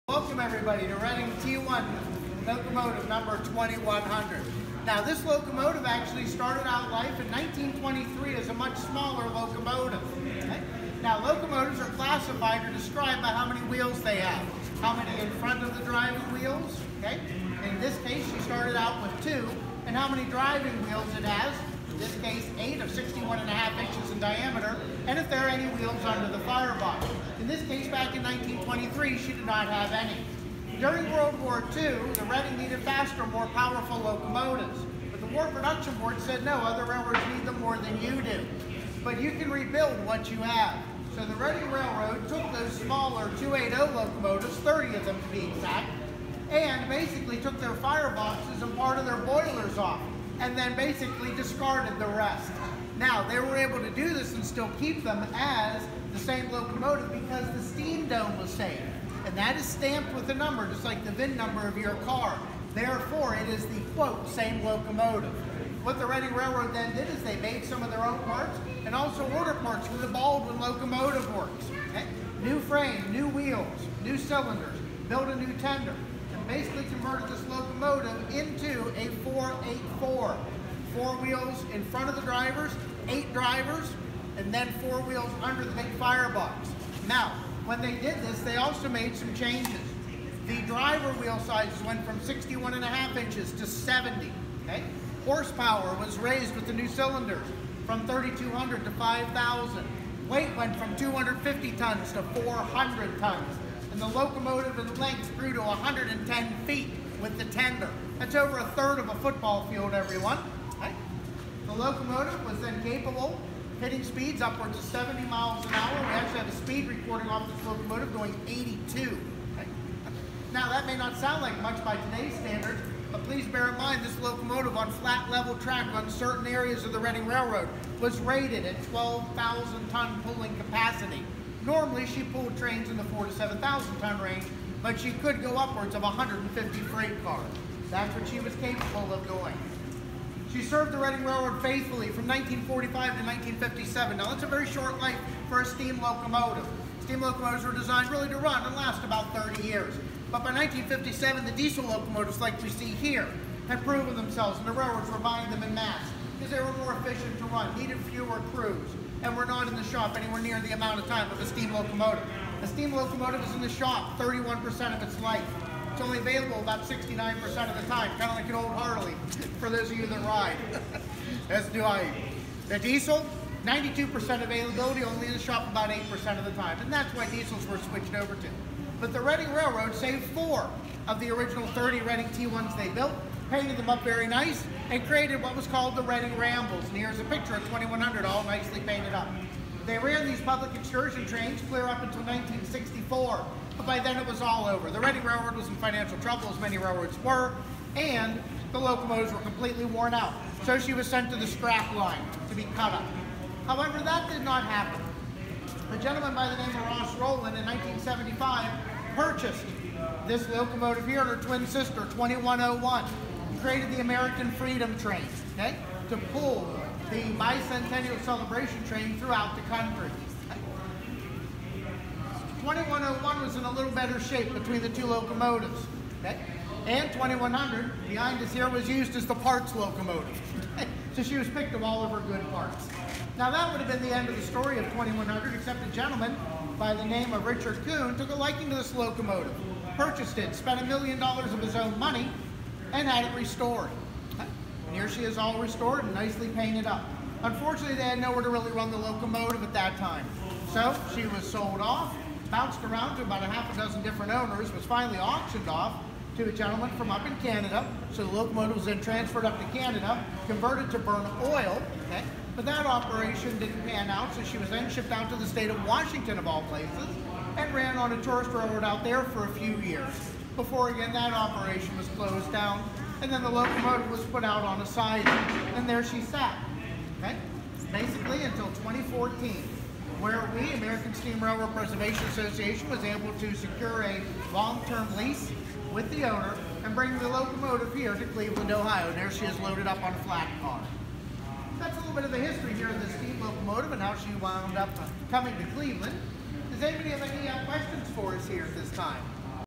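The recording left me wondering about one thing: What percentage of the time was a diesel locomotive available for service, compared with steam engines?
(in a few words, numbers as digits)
92%.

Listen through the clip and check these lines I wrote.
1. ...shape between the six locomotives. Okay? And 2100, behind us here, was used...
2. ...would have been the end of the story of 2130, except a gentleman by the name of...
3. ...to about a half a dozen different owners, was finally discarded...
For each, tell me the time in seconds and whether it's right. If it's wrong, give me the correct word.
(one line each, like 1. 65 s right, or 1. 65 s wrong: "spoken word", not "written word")
1. 224 s wrong: "two", not "six"
2. 233 s wrong: "2100", not "2130"
3. 253 s wrong: "auctioned", not "discarded".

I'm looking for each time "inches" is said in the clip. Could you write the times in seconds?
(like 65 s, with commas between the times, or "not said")
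23 s, 93 s.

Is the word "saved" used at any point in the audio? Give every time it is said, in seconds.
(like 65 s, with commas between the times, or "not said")
58 s, 179 s.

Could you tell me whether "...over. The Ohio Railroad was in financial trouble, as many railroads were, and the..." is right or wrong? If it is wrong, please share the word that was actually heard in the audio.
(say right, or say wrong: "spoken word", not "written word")
wrong: "Reading", not "Ohio".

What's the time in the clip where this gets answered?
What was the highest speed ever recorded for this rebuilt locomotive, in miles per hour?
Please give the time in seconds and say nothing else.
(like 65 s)
118 s.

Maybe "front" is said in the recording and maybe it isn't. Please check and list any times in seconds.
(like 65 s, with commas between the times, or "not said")
15 s, 81 s.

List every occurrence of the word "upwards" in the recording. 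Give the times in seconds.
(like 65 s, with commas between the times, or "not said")
114 s, 135 s.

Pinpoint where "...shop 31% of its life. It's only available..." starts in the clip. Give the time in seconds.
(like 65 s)
163 s.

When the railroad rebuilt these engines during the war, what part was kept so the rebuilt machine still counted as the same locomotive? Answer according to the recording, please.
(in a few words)
steam dome.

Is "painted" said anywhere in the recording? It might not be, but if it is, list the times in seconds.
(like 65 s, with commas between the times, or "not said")
183 s, 188 s, 246 s.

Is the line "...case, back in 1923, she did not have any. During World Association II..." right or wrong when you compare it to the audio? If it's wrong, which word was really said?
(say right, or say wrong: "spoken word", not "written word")
wrong: "War", not "Association".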